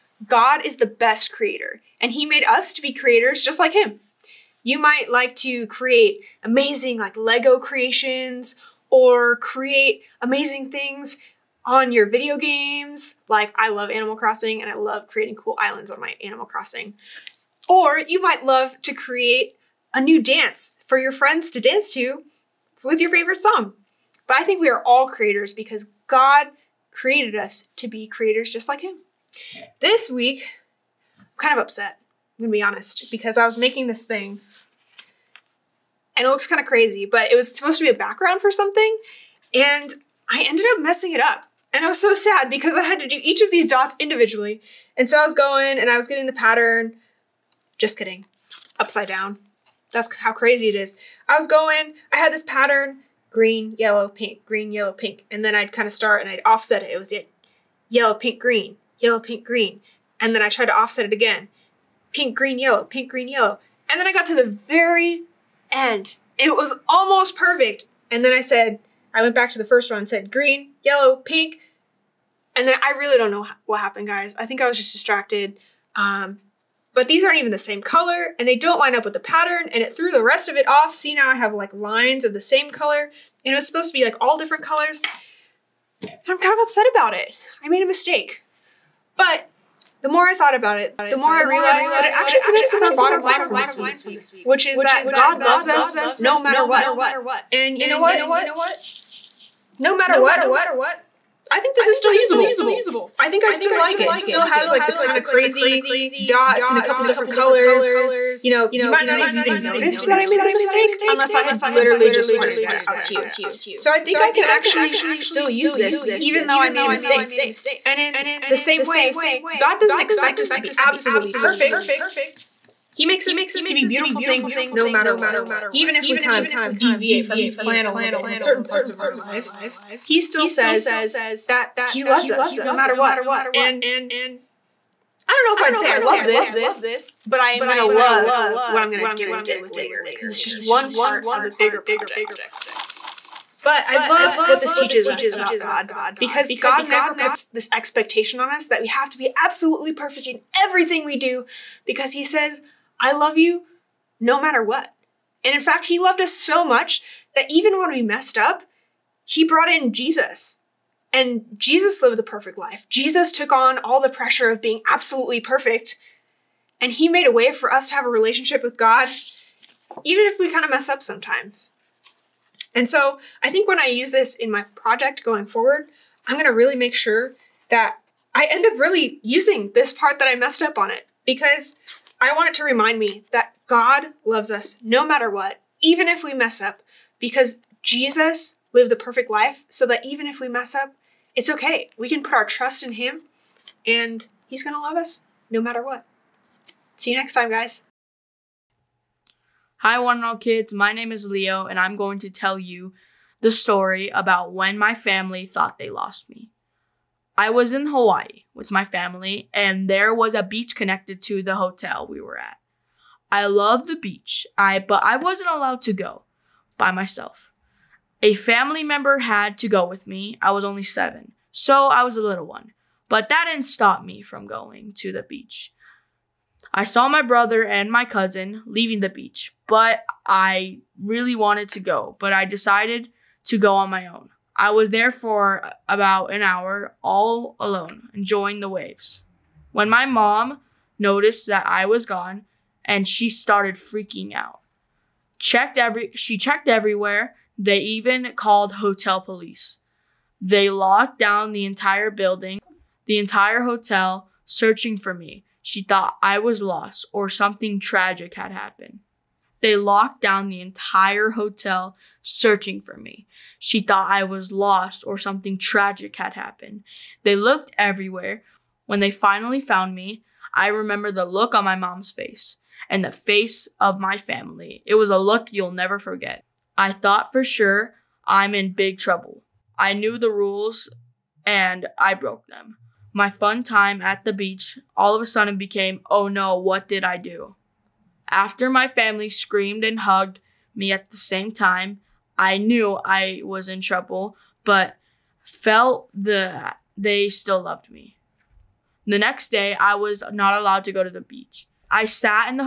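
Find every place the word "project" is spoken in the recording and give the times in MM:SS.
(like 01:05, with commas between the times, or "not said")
02:21, 02:54.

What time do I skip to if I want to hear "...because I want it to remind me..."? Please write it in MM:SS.
03:01.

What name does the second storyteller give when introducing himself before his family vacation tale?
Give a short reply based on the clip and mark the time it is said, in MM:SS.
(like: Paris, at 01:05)
Leo, at 03:21.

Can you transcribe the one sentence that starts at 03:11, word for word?
We can put our trust in Him, and He's going to love us no matter what.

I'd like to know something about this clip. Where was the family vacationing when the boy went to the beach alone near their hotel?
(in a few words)
Hawaii.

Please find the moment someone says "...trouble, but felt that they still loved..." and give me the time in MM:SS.
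04:53.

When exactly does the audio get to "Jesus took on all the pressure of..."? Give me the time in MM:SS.
02:42.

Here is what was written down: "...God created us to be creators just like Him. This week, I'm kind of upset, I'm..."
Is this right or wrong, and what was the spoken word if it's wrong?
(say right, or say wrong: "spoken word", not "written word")
right.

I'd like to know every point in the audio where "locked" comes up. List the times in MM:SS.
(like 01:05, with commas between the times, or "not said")
04:10, 04:19.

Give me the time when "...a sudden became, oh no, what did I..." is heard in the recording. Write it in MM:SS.
04:45.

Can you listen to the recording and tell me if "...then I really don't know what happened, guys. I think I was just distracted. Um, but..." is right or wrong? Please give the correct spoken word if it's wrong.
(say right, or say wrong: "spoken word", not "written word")
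right.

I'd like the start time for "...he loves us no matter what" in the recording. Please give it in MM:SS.
02:11.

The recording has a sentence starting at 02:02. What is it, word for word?
He makes us to be beautiful things no matter what.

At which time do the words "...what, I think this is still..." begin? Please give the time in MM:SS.
01:40.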